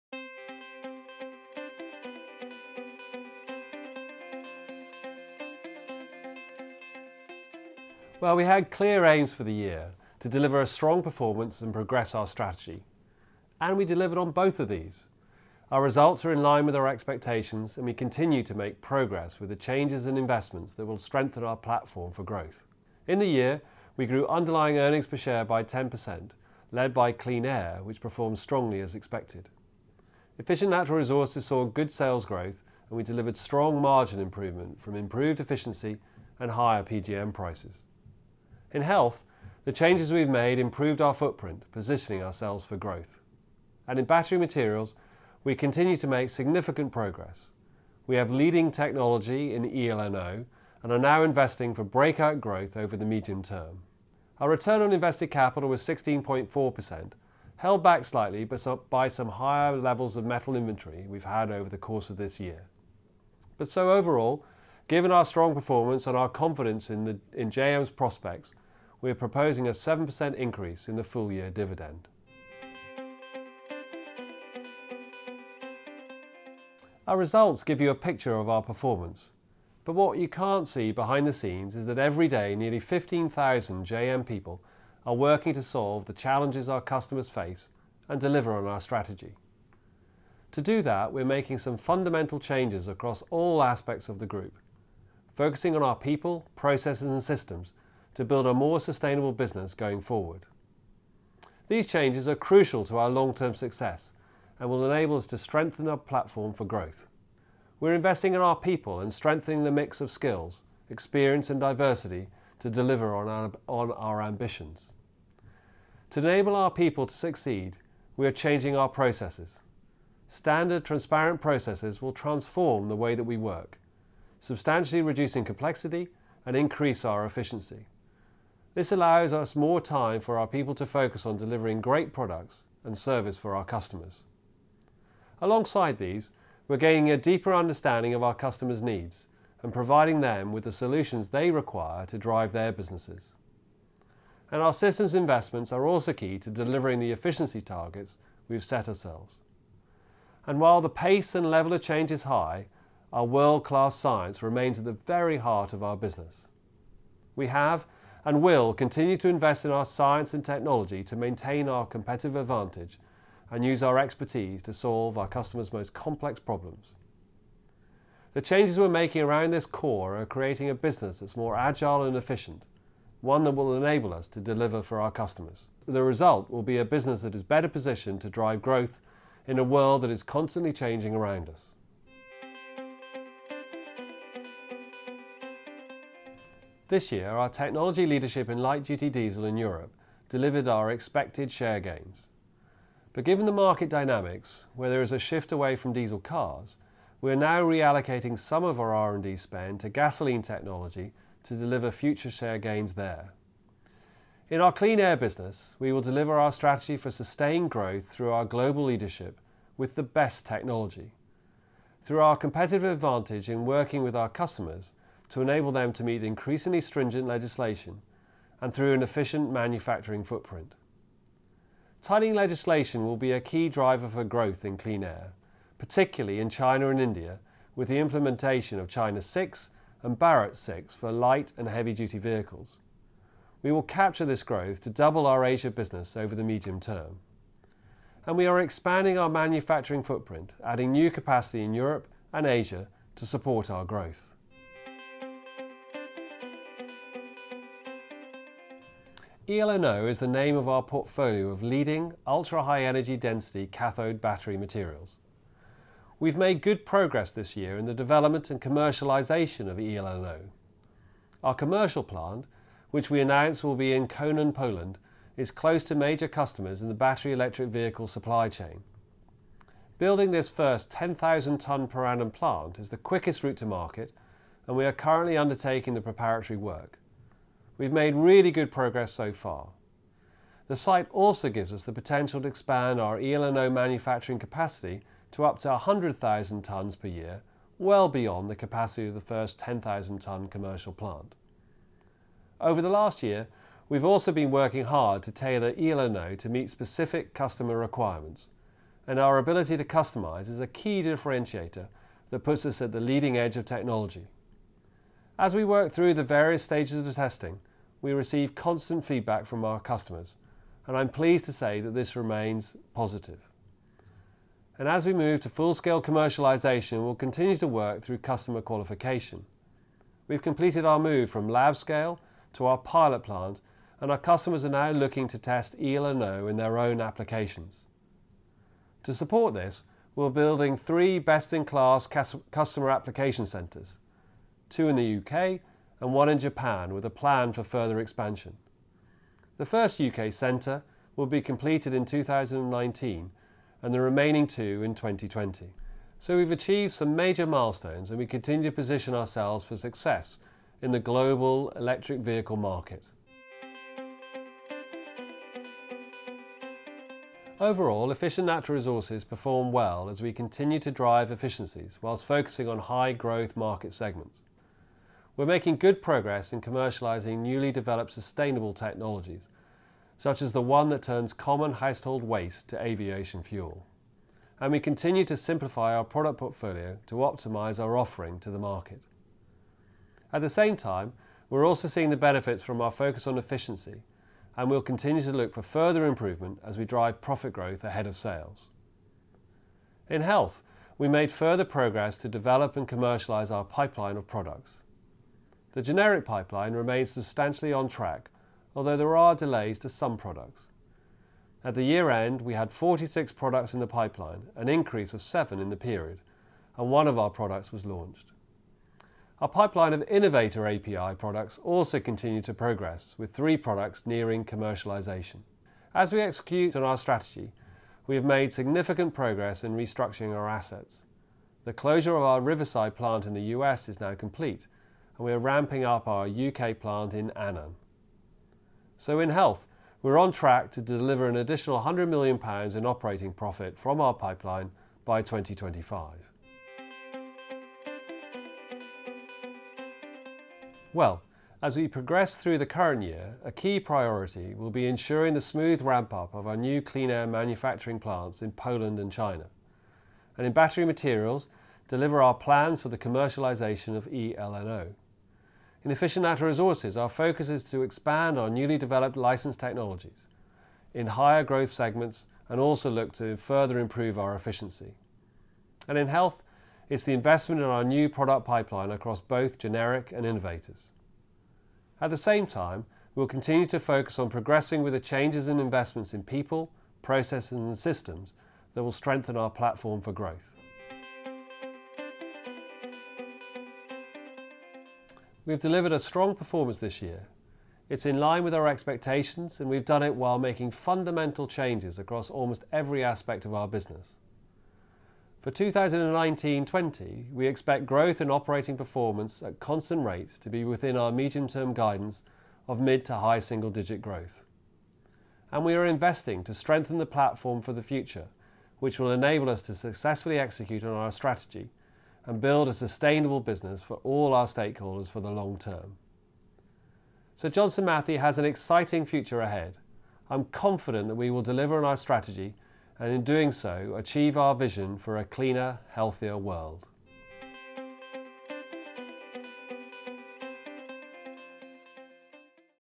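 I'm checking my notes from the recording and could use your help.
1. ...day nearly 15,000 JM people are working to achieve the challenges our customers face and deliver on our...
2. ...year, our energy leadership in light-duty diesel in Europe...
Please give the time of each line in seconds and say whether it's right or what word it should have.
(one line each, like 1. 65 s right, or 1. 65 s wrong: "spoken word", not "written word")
1. 82 s wrong: "solve", not "achieve"
2. 187 s wrong: "technology", not "energy".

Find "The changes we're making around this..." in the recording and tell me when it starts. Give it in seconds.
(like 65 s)
168 s.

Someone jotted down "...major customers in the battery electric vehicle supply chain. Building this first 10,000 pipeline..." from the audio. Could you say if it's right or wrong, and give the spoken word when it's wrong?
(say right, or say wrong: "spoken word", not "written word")
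wrong: "tonne", not "pipeline".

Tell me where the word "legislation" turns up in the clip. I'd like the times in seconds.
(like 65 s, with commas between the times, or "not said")
217 s, 222 s.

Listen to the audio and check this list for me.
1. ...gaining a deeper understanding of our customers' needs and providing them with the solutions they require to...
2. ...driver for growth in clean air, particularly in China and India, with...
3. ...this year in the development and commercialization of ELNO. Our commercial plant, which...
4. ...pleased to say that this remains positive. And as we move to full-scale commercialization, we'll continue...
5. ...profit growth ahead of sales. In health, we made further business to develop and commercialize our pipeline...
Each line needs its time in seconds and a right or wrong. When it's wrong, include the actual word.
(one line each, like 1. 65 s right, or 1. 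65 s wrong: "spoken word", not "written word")
1. 136 s right
2. 223 s right
3. 257 s right
4. 311 s right
5. 387 s wrong: "progress", not "business".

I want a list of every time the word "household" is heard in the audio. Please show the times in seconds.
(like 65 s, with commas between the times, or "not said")
371 s.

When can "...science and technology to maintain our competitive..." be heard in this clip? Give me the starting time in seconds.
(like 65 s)
159 s.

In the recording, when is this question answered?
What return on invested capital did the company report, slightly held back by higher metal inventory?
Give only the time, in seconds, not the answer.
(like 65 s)
55 s.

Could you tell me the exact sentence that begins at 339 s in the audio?
The first UK centre will be completed in 2019 and the remaining two in 2020.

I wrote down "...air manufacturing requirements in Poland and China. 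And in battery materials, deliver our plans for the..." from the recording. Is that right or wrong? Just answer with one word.
wrong.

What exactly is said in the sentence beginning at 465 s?
And in health, it's the investment in our new product pipeline across both generic and innovators.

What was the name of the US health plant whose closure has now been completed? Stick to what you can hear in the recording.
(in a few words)
Riverside.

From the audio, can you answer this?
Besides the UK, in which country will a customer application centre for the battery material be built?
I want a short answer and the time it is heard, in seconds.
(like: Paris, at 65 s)
Japan, at 336 s.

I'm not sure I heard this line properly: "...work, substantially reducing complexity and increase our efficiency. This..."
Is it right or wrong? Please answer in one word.
right.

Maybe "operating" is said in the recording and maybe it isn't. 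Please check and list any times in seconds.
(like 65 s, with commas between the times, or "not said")
432 s, 498 s.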